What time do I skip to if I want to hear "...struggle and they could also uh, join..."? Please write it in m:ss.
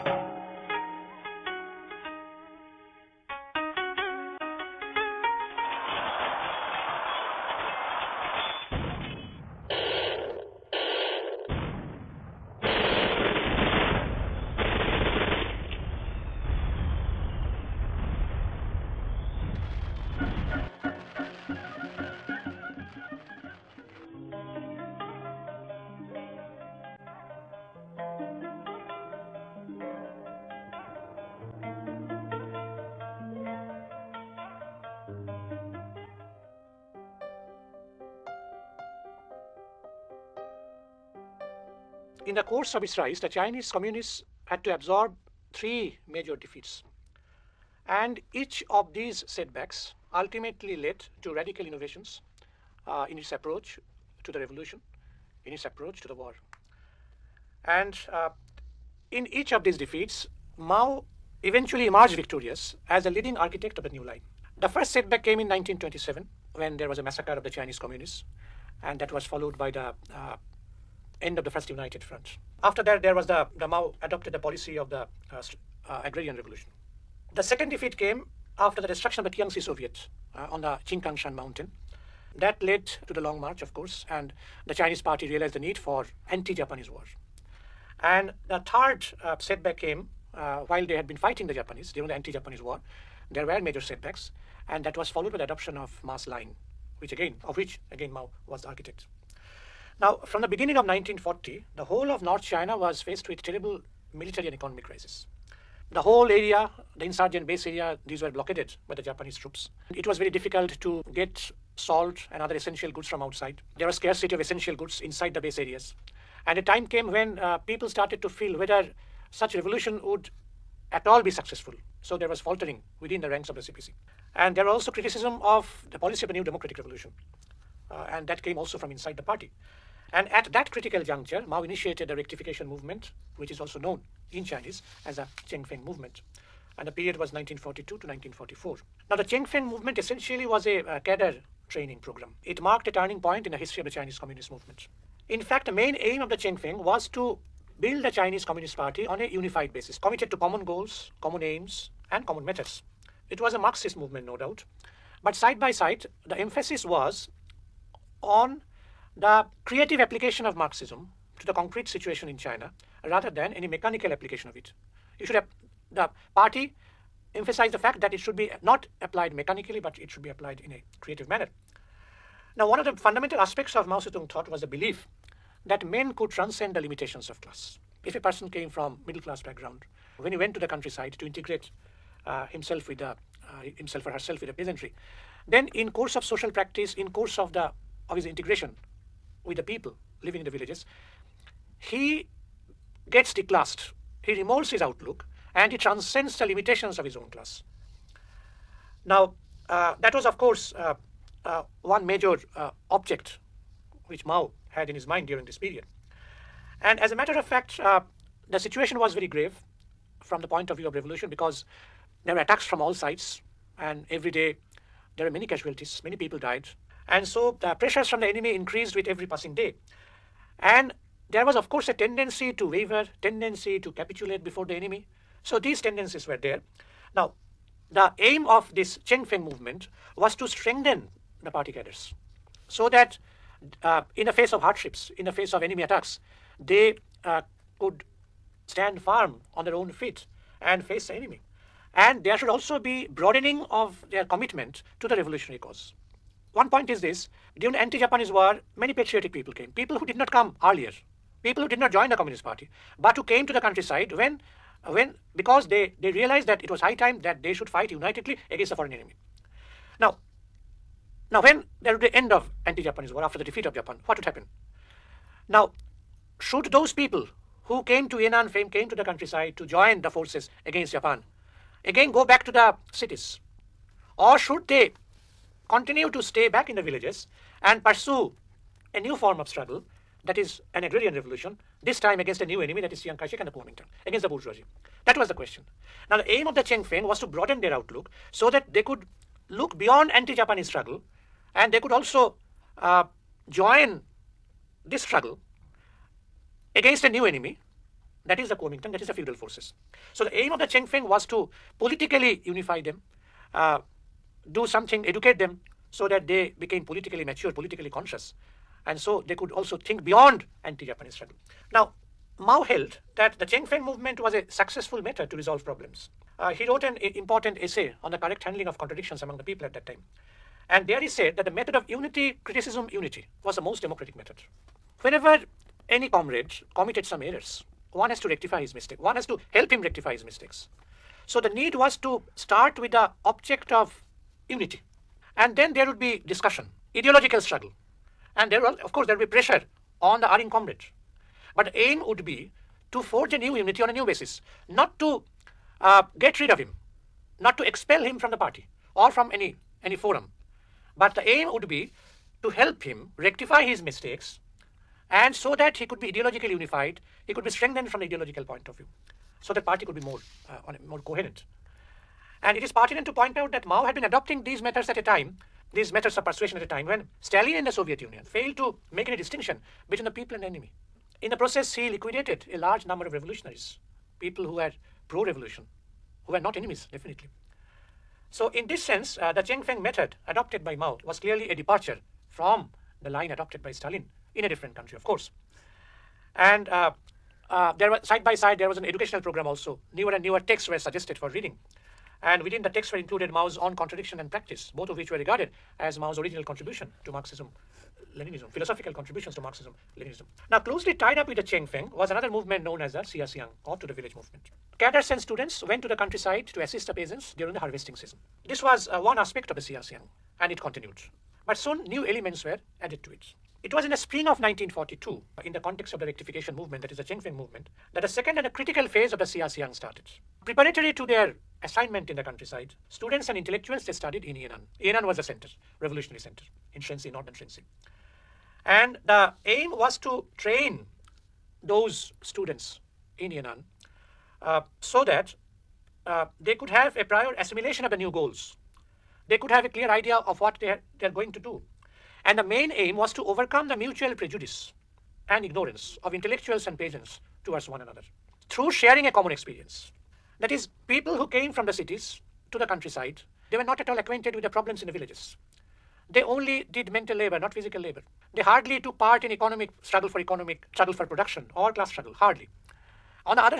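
4:50.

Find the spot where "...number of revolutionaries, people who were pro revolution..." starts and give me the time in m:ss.
6:12.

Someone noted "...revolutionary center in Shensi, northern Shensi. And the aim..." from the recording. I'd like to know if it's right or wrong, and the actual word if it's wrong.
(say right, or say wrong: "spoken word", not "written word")
right.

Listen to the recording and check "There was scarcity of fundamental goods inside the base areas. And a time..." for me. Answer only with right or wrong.
wrong.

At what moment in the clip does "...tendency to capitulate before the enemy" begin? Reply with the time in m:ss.
3:43.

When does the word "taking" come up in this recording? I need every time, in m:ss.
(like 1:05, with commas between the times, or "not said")
not said.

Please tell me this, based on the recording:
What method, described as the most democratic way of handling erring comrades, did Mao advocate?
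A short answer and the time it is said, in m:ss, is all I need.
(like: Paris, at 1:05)
unity, criticism, unity, at 5:21.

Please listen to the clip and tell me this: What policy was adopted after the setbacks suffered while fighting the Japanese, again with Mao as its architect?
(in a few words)
mass line.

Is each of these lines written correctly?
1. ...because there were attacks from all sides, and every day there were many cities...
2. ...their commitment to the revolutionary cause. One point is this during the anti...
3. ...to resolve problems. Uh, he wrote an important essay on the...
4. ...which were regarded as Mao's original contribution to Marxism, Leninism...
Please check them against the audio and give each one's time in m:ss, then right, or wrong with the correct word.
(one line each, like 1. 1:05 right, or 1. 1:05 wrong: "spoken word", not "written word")
1. 3:31 wrong: "casualties", not "cities"
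2. 4:04 right
3. 5:15 right
4. 6:34 right.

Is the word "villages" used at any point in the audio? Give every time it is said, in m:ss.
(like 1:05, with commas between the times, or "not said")
3:10, 4:36, 6:43, 7:34.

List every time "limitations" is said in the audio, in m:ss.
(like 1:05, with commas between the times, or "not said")
2:56, 3:16.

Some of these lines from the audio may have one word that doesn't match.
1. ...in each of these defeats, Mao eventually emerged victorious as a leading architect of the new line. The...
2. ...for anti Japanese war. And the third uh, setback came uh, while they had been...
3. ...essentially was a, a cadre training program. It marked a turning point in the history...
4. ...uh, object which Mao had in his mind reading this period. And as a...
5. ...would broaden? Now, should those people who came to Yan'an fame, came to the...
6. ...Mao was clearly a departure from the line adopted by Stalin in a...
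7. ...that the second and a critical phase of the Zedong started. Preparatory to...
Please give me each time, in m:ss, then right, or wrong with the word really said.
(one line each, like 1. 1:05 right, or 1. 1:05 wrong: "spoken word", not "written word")
1. 0:59 right
2. 1:25 right
3. 2:19 right
4. 3:22 wrong: "during", not "reading"
5. 4:24 wrong: "happen", not "broaden"
6. 6:20 right
7. 6:57 wrong: "Xiaxiang", not "Zedong".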